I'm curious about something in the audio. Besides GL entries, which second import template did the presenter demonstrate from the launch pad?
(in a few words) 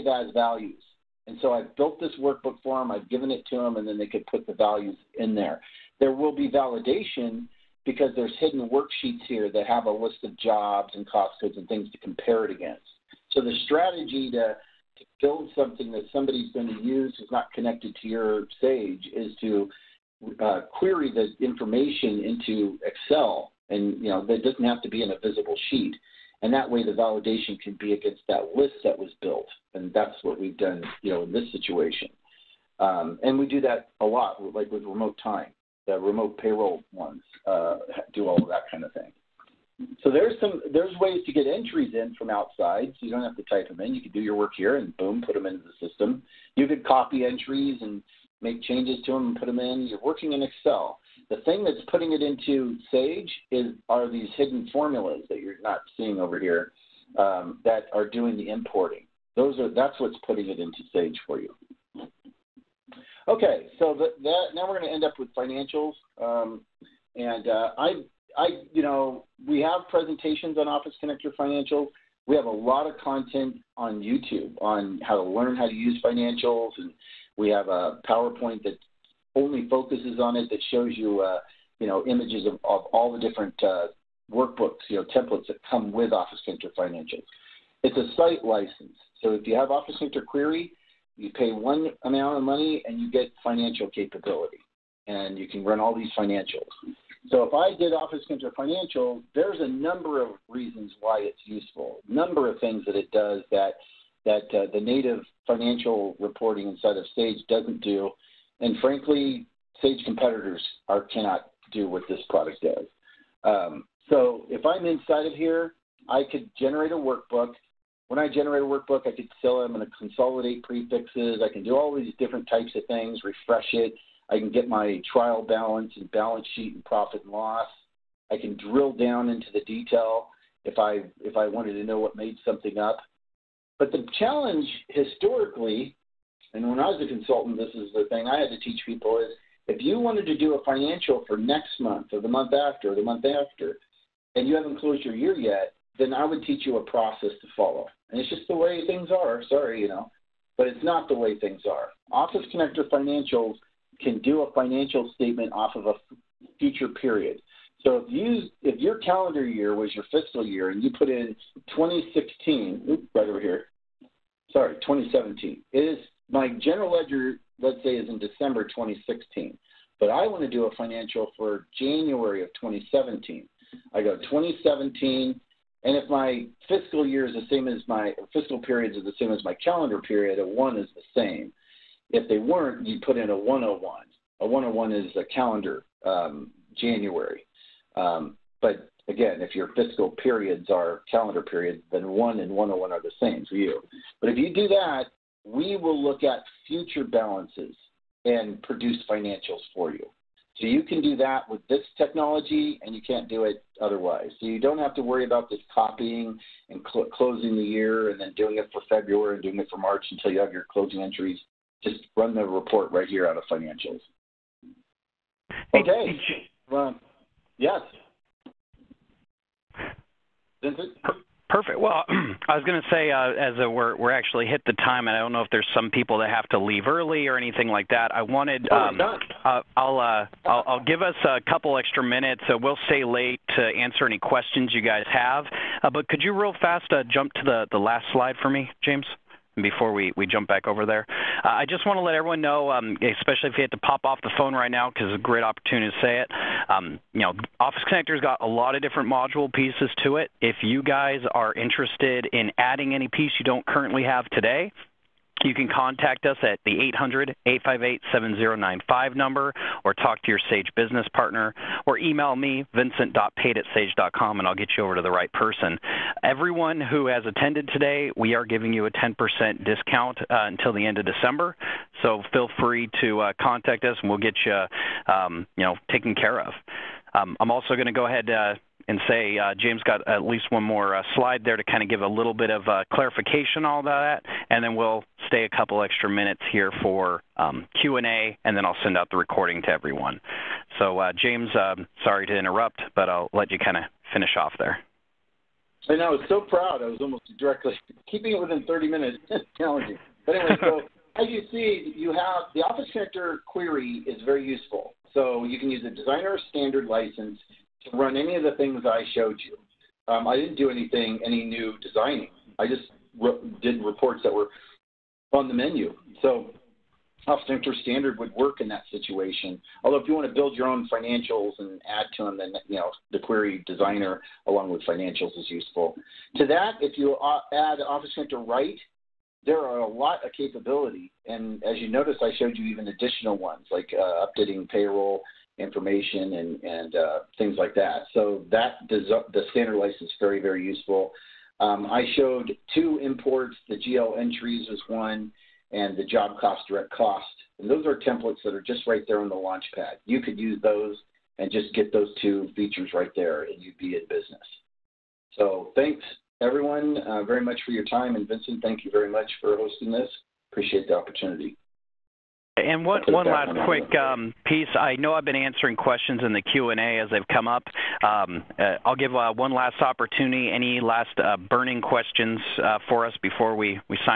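job cost direct cost.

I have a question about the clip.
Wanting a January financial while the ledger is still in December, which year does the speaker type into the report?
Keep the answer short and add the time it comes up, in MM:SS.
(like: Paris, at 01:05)
2017, at 02:53.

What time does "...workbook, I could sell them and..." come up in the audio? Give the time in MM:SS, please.
01:58.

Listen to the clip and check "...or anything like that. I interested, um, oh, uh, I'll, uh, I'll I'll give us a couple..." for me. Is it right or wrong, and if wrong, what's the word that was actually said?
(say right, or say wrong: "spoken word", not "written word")
wrong: "wanted", not "interested".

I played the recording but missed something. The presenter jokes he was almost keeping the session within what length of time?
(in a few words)
30 minutes.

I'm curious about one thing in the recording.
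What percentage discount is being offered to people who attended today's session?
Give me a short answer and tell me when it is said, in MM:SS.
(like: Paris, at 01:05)
10%, at 04:28.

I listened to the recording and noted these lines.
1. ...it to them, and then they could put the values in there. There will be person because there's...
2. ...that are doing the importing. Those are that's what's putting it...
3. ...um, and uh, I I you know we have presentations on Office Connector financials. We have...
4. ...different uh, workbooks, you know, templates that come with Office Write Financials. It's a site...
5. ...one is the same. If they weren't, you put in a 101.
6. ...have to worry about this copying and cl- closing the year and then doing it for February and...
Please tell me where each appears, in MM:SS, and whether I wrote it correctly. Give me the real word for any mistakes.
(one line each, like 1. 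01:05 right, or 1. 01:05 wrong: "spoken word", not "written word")
1. 00:03 wrong: "validation", not "person"
2. 00:57 right
3. 01:06 right
4. 01:23 wrong: "Connector", not "Write"
5. 03:00 right
6. 03:24 right.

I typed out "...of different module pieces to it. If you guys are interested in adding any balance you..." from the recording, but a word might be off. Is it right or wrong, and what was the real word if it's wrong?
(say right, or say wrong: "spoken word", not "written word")
wrong: "piece", not "balance".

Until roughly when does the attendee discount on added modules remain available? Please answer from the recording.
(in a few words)
end of December.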